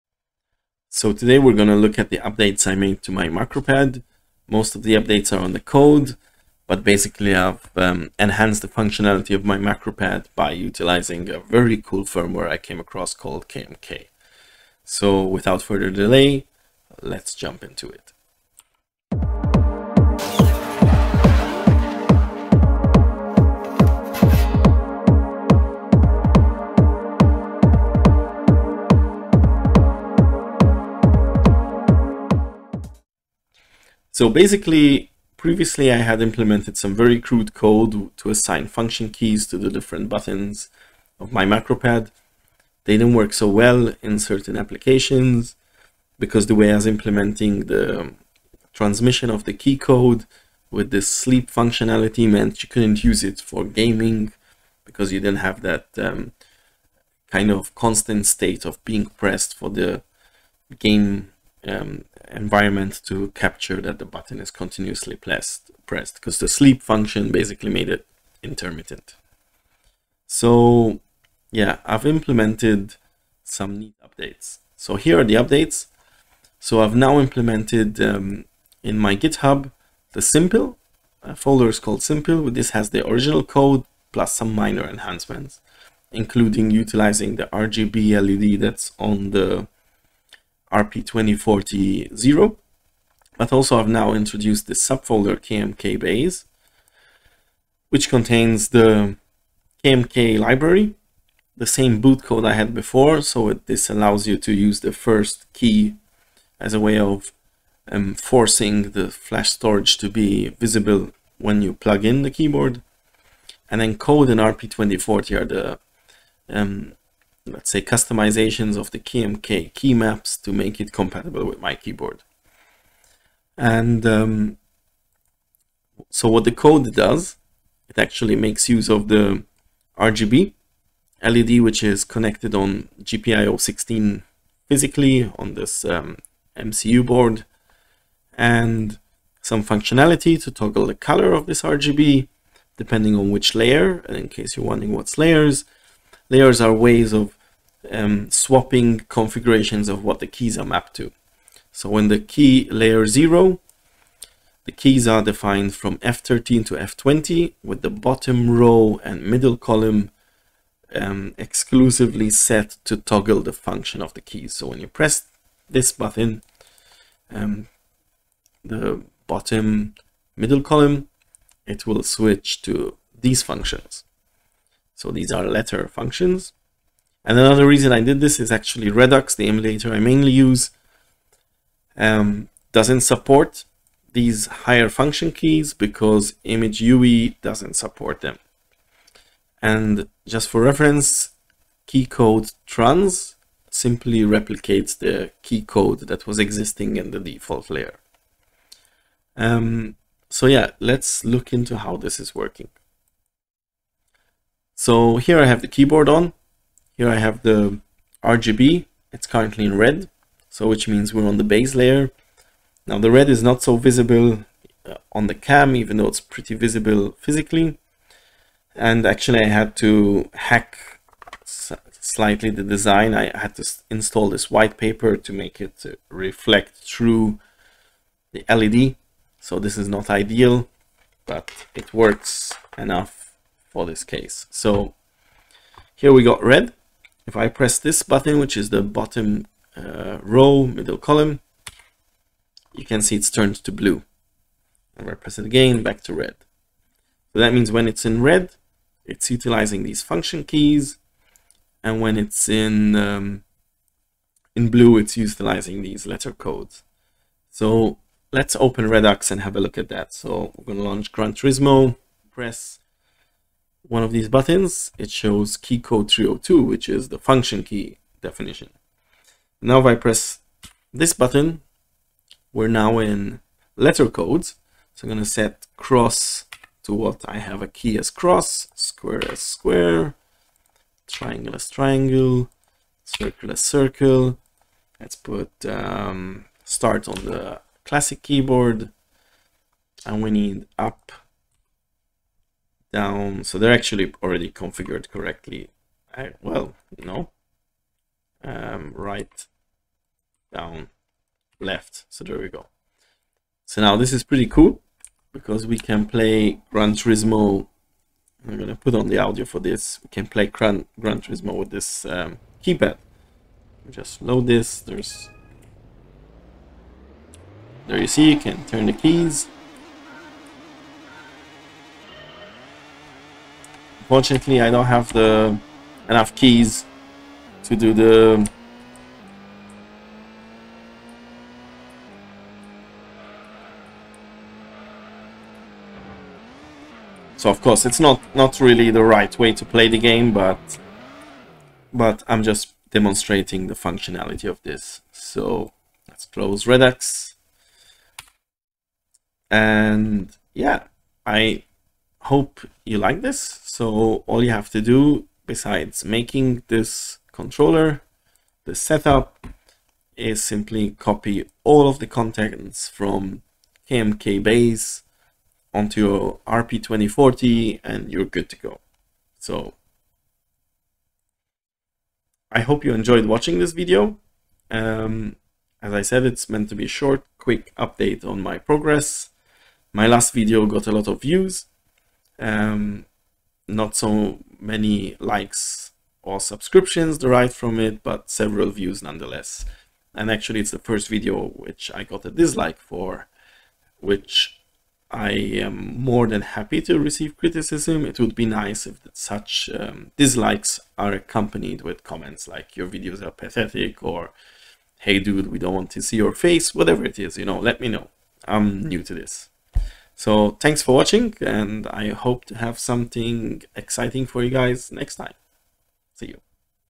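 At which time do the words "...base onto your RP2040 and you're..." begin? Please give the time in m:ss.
6:04.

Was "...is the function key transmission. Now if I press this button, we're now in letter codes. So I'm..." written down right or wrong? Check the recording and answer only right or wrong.
wrong.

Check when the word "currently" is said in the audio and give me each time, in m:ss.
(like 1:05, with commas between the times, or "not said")
3:29.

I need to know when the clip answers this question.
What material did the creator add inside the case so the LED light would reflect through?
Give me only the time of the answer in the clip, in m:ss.
3:44.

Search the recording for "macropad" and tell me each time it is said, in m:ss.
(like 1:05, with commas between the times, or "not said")
0:03, 0:09, 0:41.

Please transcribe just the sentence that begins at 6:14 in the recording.
Um, as I said, it's meant to be a short, quick update on my progress.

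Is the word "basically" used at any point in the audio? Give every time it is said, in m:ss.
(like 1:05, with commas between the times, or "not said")
0:06, 0:34, 1:07.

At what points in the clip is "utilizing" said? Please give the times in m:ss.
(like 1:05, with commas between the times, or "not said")
0:10, 1:26, 4:09, 4:15.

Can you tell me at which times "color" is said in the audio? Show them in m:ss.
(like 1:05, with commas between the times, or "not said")
2:20.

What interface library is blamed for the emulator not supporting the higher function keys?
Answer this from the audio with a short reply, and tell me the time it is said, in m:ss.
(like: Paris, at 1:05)
ImGui, at 3:06.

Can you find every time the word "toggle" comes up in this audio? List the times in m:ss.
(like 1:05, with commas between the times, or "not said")
2:20, 2:42.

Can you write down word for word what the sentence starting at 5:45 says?
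So let's close Redux, and yeah, I hope you like this.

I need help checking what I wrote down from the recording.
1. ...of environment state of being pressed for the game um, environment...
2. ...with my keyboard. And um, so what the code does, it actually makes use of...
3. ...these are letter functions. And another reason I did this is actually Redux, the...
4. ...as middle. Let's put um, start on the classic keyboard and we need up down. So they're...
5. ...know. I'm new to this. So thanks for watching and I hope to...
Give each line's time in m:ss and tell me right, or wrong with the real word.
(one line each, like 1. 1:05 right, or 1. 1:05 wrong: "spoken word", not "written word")
1. 0:57 wrong: "constant", not "environment"
2. 2:01 right
3. 2:55 right
4. 4:43 wrong: "circle", not "middle"
5. 6:47 right.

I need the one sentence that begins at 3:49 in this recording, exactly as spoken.
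So this is not ideal, but it works enough for this case.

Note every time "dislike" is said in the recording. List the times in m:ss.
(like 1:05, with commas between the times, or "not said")
6:32, 6:40.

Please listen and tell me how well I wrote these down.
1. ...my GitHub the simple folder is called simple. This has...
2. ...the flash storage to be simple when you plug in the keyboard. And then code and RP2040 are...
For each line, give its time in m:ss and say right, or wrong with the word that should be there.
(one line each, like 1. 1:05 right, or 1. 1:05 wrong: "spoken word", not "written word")
1. 1:18 right
2. 1:48 wrong: "visible", not "simple".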